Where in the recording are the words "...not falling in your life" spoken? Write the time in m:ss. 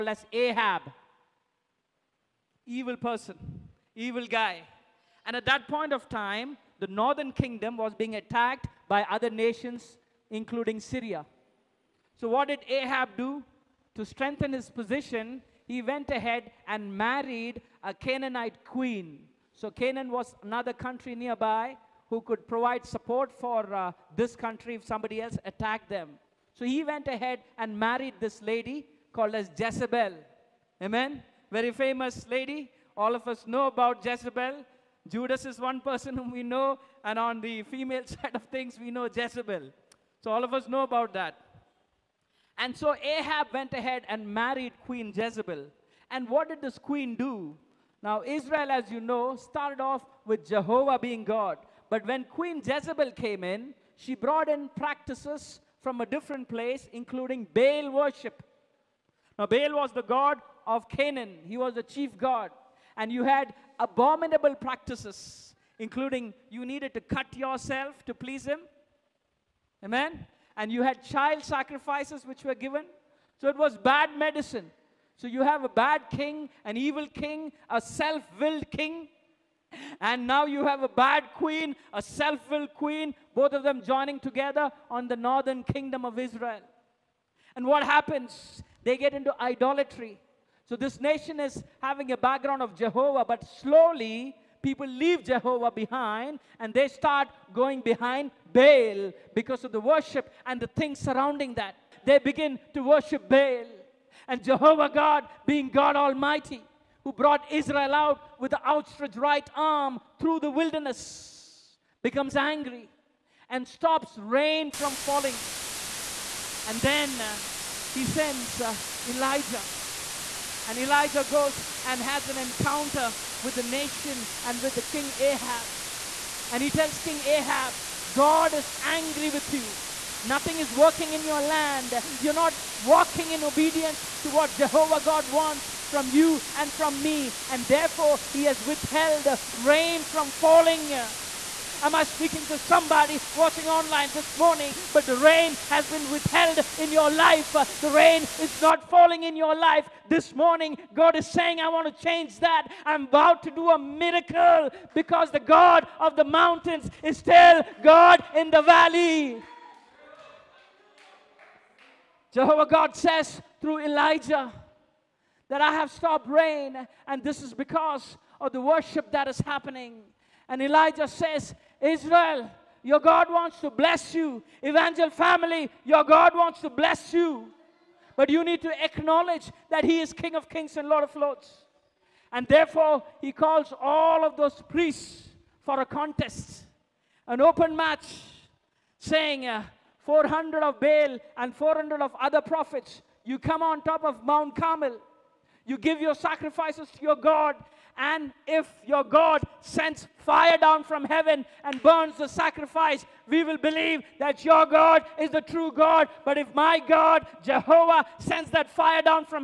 2:28.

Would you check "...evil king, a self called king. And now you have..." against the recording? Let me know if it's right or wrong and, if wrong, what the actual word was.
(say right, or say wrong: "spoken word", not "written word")
wrong: "willed", not "called".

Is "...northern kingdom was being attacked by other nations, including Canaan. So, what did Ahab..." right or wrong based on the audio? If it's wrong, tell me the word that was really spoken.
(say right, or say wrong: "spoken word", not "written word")
wrong: "Syria", not "Canaan".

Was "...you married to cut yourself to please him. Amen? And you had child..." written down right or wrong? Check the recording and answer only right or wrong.
wrong.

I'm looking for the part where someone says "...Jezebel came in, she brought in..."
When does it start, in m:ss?
0:52.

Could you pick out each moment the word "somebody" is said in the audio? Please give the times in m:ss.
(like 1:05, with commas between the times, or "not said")
0:24, 2:22.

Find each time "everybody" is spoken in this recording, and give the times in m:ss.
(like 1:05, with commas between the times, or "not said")
not said.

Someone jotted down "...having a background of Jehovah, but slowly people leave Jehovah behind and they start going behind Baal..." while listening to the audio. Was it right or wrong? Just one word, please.
right.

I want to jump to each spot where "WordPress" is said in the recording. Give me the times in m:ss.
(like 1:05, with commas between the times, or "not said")
not said.